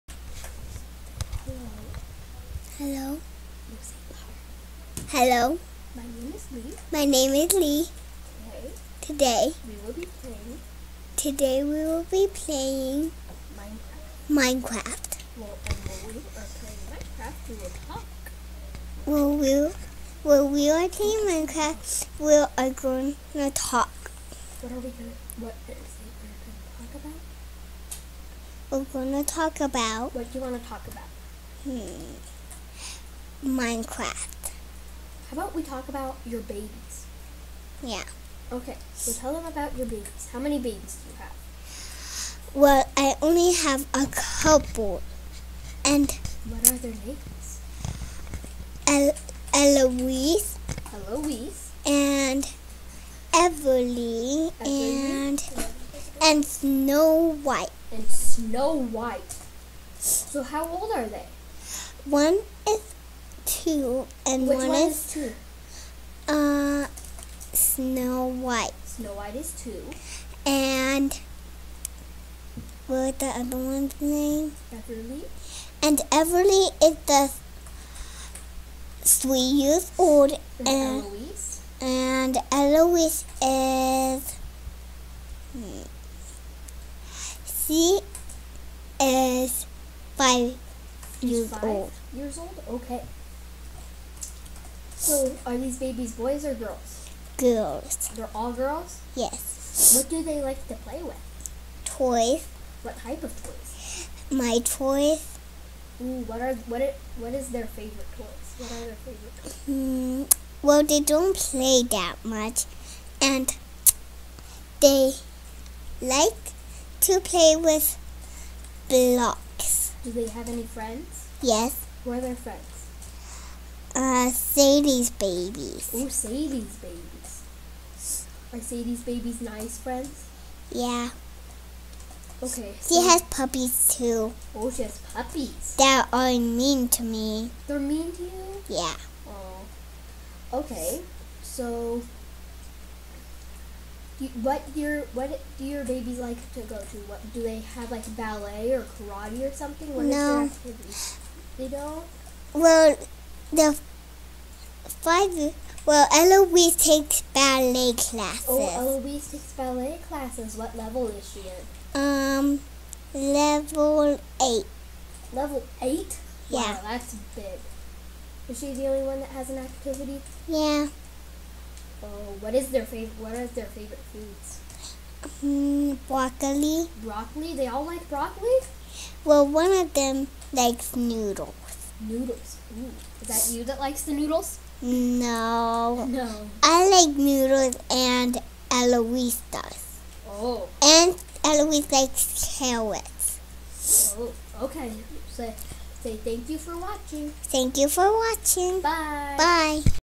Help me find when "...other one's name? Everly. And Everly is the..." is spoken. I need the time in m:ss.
1:13.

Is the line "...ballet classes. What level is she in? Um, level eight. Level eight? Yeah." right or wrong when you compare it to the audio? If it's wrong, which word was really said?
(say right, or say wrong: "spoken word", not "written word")
right.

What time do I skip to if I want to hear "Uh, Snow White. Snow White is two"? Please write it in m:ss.
1:06.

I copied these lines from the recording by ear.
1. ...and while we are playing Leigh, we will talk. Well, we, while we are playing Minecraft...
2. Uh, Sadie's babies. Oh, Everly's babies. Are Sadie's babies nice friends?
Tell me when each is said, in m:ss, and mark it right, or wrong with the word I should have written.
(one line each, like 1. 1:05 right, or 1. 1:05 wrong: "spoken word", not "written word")
1. 0:15 wrong: "Minecraft", not "Leigh"
2. 2:03 wrong: "Sadie", not "Everly".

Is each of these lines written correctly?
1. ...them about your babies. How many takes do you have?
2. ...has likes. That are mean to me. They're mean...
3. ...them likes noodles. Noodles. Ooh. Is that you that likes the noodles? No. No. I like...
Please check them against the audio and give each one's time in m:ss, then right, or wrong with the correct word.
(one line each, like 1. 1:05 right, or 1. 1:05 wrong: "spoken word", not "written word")
1. 0:39 wrong: "babies", not "takes"
2. 2:14 wrong: "puppies", not "likes"
3. 2:59 right.